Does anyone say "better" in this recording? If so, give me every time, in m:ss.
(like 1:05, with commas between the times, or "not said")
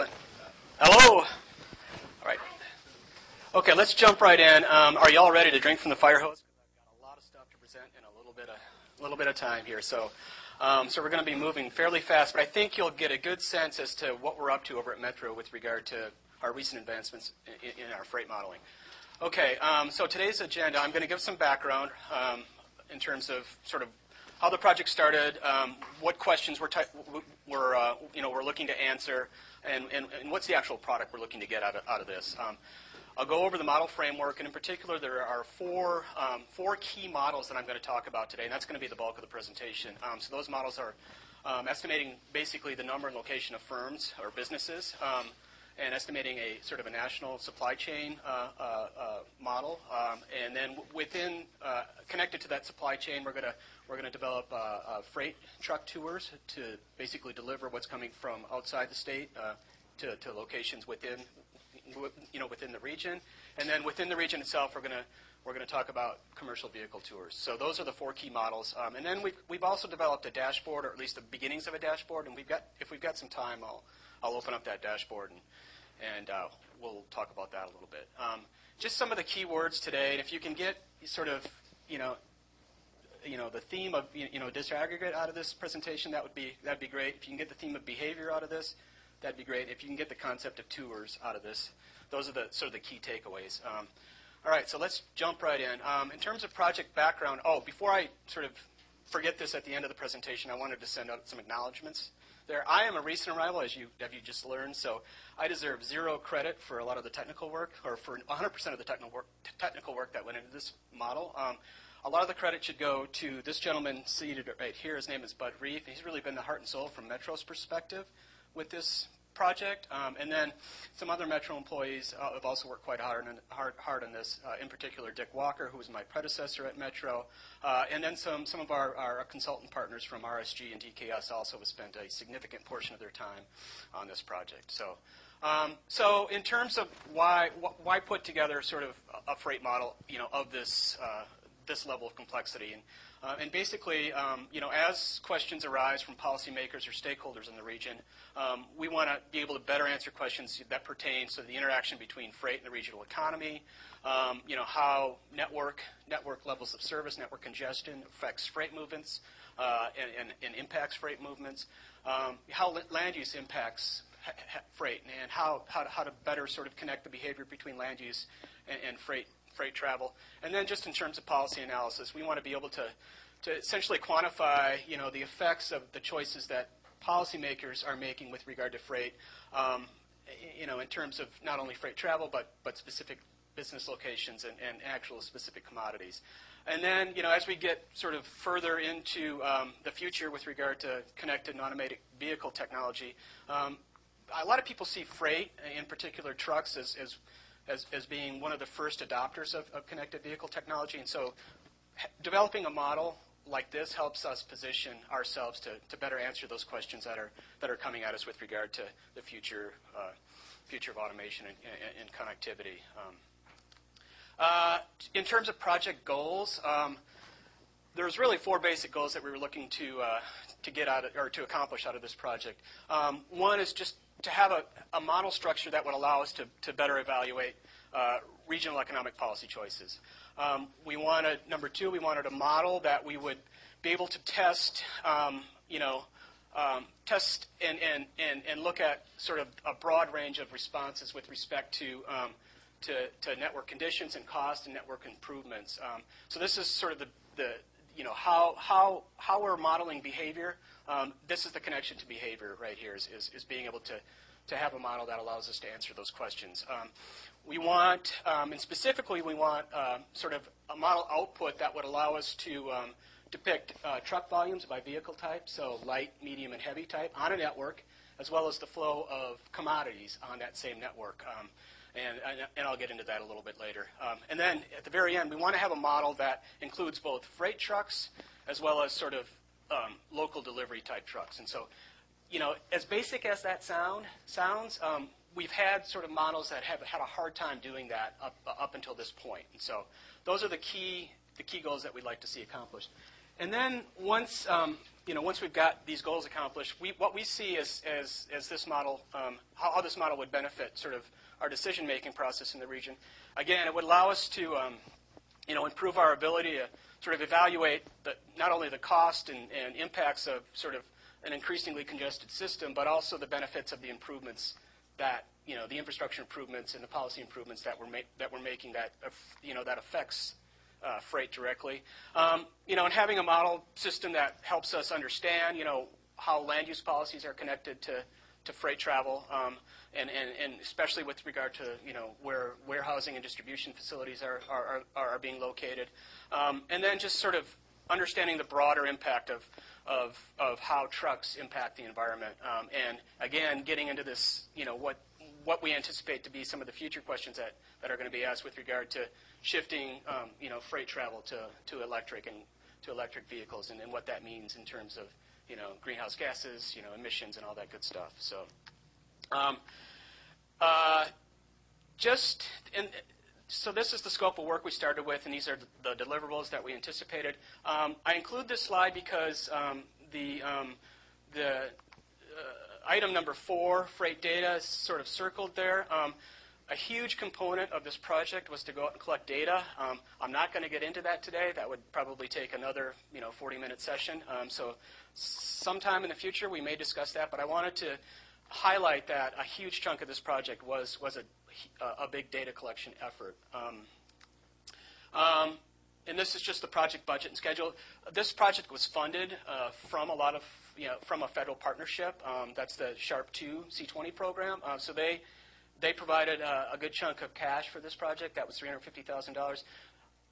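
2:29, 2:46, 3:25, 3:46.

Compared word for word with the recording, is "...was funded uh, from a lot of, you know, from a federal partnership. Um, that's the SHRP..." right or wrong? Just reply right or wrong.
right.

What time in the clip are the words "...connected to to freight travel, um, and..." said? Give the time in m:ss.
5:27.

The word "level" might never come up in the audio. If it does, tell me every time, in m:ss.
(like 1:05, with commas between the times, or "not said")
2:21, 2:36.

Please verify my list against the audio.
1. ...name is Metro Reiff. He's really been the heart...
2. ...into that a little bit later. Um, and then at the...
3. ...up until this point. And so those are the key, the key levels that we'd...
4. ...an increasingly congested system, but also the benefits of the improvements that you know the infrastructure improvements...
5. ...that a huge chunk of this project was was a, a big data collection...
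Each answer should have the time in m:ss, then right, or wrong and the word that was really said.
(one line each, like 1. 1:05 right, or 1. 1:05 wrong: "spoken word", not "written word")
1. 1:55 wrong: "Bud", not "Metro"
2. 4:32 right
3. 4:48 wrong: "goals", not "levels"
4. 5:11 right
5. 6:29 right.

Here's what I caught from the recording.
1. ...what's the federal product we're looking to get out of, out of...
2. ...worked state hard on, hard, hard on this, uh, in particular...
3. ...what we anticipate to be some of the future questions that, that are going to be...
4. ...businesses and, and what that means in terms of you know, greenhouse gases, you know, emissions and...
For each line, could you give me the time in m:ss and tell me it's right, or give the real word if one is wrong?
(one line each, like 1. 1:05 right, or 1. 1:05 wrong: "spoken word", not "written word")
1. 0:30 wrong: "actual", not "federal"
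2. 2:02 wrong: "quite", not "state"
3. 5:45 right
4. 5:53 wrong: "vehicles", not "businesses".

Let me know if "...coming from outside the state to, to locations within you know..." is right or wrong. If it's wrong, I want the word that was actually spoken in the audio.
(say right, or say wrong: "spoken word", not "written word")
right.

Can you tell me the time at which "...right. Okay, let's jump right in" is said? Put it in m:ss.
0:02.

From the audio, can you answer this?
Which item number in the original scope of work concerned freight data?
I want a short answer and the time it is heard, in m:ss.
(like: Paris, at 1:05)
4, at 6:13.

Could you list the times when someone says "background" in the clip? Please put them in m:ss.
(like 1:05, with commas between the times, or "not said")
0:21, 1:36.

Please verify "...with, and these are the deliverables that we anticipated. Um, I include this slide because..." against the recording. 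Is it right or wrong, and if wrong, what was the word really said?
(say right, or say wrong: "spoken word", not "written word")
right.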